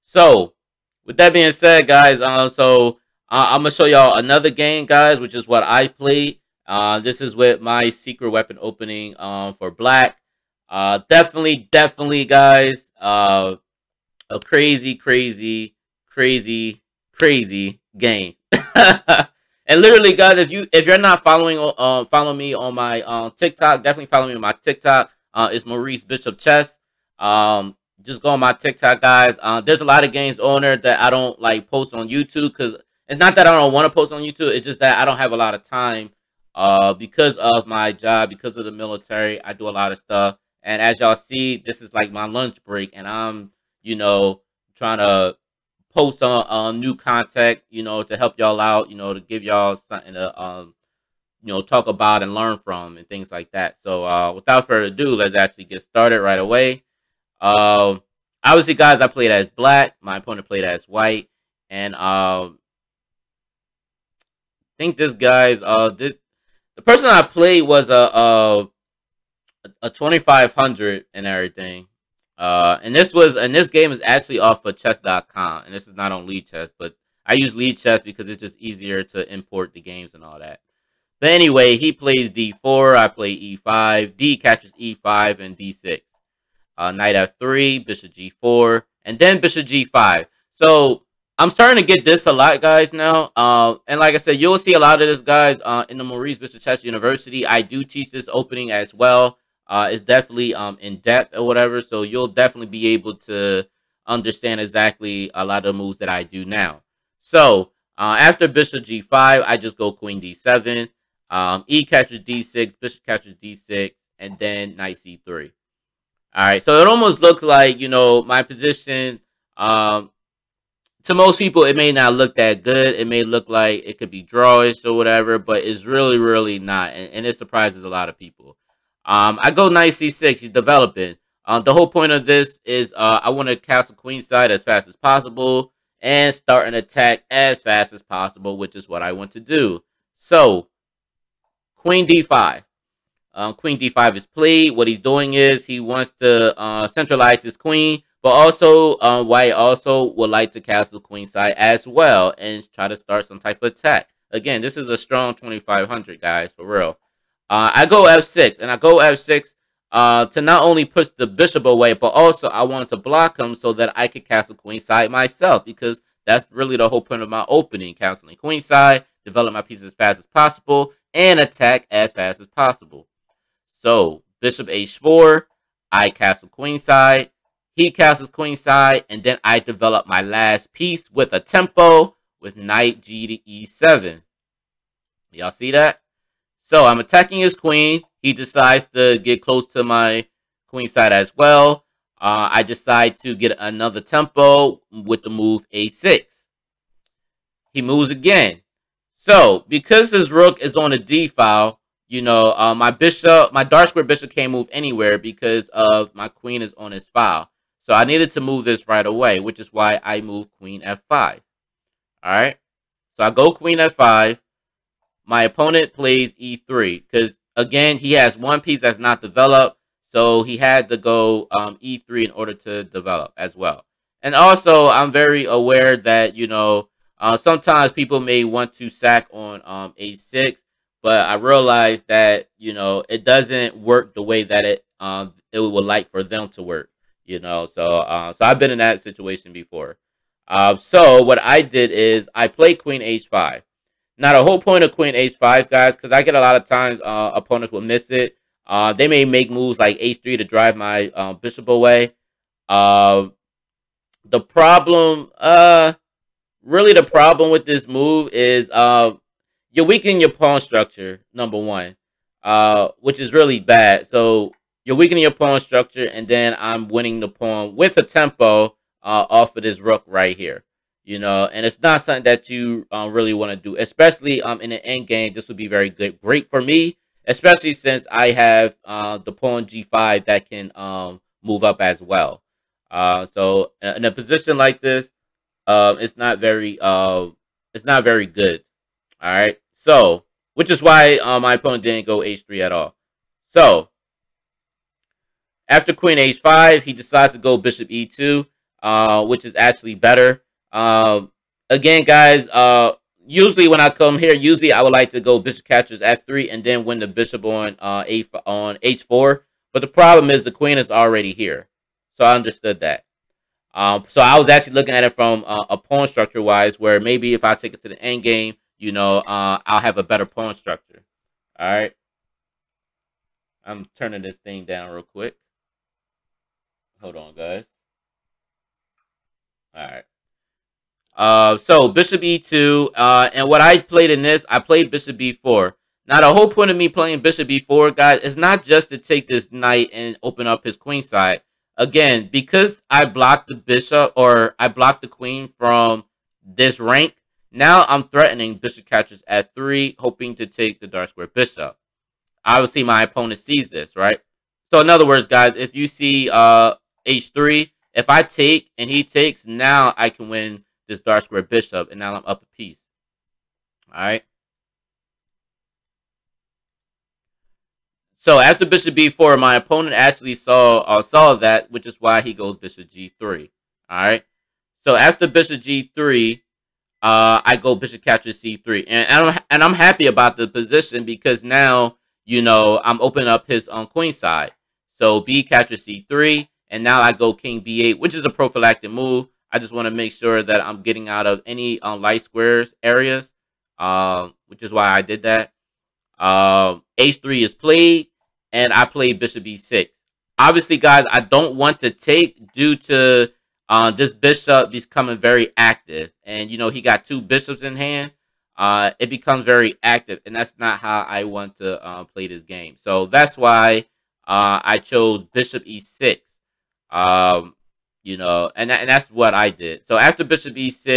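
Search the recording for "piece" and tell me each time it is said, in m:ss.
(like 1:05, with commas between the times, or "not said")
2:49, 3:00, 3:38, 6:02.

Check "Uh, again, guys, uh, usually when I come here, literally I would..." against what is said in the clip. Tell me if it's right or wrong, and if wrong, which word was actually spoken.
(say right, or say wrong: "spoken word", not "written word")
wrong: "usually", not "literally".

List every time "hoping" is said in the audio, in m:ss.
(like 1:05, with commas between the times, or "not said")
5:49.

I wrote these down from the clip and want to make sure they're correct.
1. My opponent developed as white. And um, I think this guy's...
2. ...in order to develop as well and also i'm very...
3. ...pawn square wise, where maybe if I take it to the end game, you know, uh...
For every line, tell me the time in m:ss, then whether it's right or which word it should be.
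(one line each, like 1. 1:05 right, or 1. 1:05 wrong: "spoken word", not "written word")
1. 1:00 wrong: "played", not "developed"
2. 3:42 right
3. 5:15 wrong: "structure", not "square".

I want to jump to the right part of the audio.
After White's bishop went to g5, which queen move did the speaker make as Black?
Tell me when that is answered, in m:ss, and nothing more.
1:49.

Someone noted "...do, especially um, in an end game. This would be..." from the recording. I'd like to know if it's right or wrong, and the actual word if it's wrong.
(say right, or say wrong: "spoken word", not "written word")
right.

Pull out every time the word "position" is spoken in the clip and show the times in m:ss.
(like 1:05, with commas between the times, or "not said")
1:58, 4:44, 6:20.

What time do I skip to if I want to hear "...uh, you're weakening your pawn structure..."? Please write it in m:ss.
4:18.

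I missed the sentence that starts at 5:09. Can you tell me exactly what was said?
But the problem is the queen is already here.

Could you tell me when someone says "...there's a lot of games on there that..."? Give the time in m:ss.
0:29.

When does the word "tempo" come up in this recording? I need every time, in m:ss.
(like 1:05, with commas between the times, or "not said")
3:01, 3:13, 4:28.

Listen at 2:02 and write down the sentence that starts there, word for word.
It may look like it could be drawish or whatever, but it's really, really not.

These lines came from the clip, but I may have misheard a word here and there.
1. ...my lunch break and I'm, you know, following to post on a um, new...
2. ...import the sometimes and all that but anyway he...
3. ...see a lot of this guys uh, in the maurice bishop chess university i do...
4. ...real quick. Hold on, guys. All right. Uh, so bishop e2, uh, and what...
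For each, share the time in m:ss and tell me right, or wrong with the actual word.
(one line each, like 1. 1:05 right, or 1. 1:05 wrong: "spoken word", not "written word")
1. 0:42 wrong: "trying", not "following"
2. 1:19 wrong: "games", not "sometimes"
3. 1:34 right
4. 5:24 right.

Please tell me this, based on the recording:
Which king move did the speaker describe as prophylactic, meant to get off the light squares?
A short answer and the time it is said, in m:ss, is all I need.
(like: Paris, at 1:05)
King b8, at 6:27.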